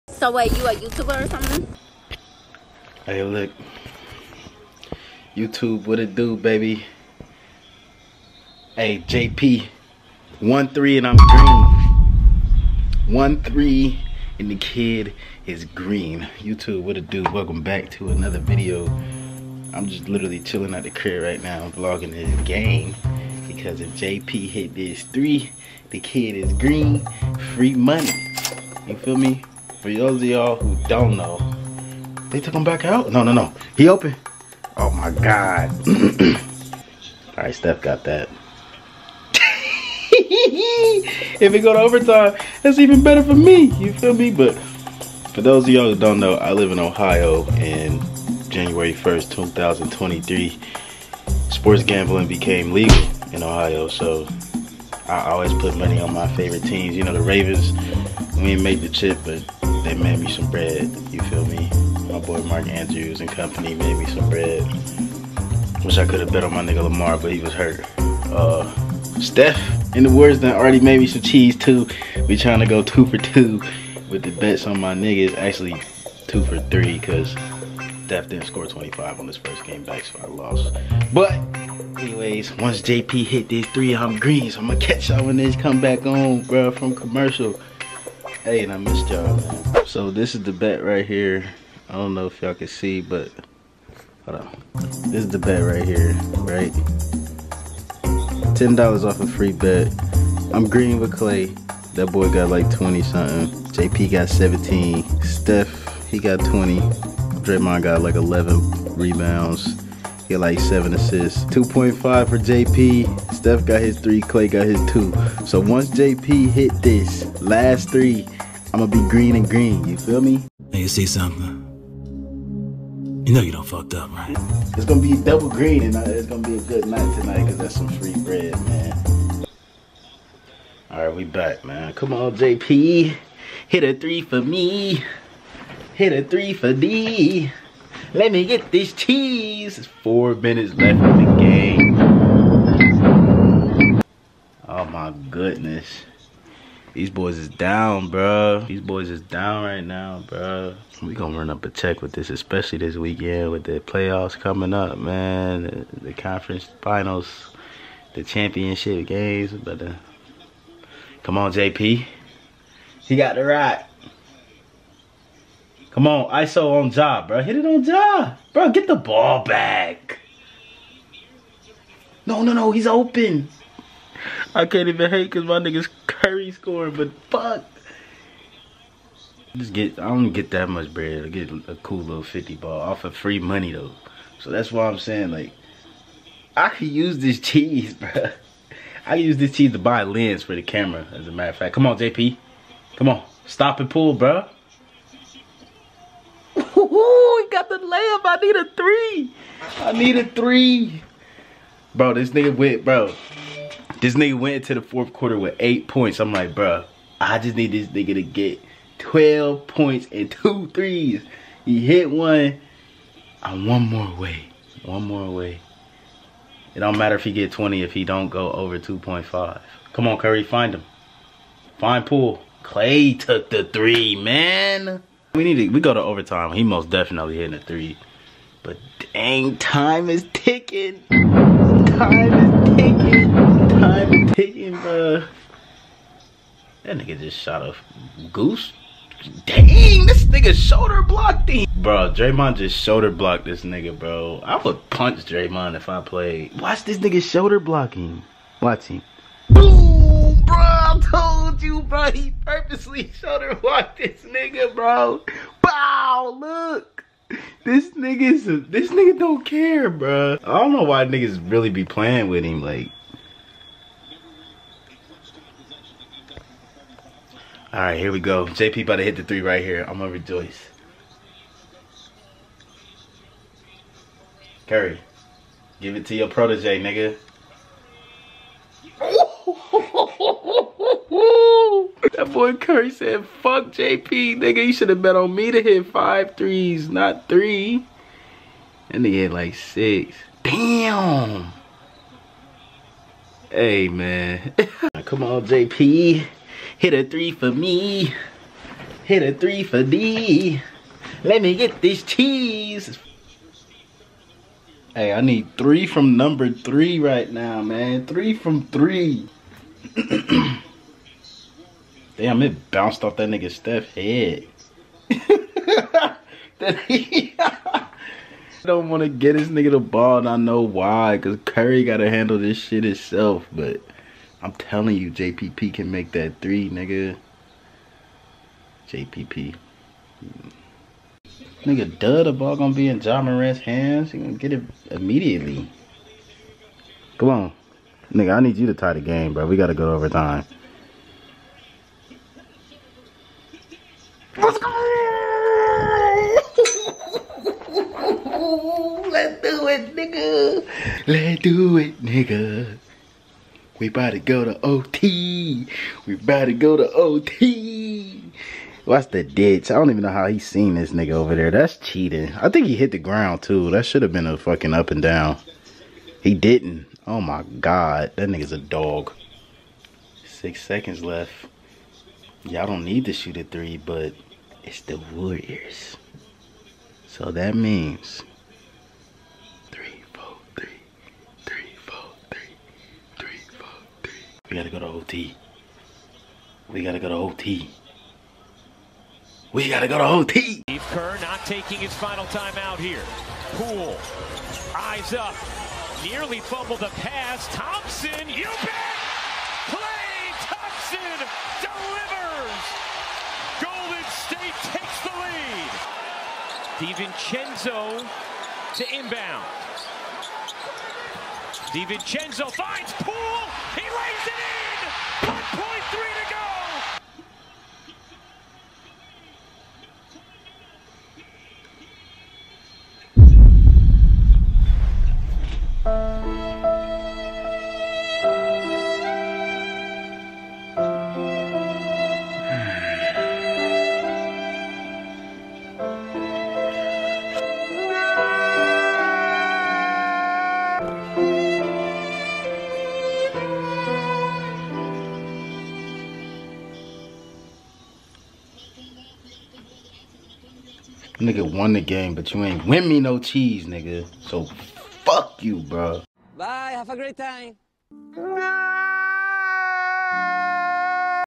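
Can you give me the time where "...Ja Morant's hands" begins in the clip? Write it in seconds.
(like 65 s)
333 s.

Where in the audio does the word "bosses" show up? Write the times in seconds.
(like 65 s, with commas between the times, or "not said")
not said.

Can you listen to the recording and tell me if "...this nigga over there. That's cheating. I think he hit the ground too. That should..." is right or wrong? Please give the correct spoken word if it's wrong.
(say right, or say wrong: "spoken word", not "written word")
right.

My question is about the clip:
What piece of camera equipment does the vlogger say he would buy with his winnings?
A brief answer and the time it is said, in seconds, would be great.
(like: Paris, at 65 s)
A lens, at 190 s.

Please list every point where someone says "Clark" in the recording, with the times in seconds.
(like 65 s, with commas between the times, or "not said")
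not said.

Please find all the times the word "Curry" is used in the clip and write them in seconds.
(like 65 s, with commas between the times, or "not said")
176 s, 220 s, 274 s, 282 s, 321 s.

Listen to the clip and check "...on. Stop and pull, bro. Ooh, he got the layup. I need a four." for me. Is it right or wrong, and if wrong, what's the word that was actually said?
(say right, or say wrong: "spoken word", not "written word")
wrong: "three", not "four".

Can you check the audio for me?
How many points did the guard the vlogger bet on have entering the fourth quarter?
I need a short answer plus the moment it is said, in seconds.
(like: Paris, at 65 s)
8, at 205 s.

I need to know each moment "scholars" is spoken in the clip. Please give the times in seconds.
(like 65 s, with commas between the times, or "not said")
not said.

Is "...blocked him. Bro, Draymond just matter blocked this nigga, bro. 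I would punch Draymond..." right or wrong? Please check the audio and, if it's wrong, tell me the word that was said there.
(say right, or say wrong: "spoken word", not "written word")
wrong: "shoulder", not "matter".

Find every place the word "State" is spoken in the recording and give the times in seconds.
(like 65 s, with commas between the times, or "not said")
404 s.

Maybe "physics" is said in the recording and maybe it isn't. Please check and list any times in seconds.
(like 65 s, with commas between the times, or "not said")
not said.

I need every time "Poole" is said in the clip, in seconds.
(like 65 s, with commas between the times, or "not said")
222 s, 393 s, 412 s.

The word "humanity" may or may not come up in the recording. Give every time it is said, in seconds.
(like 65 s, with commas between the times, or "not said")
not said.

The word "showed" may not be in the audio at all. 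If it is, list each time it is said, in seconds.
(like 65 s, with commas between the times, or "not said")
253 s.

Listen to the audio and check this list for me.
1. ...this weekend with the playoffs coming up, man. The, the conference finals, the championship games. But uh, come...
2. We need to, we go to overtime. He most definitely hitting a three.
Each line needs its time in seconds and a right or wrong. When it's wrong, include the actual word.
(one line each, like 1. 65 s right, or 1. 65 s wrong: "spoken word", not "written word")
1. 152 s right
2. 225 s right.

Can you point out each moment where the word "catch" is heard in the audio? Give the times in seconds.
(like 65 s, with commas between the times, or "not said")
84 s.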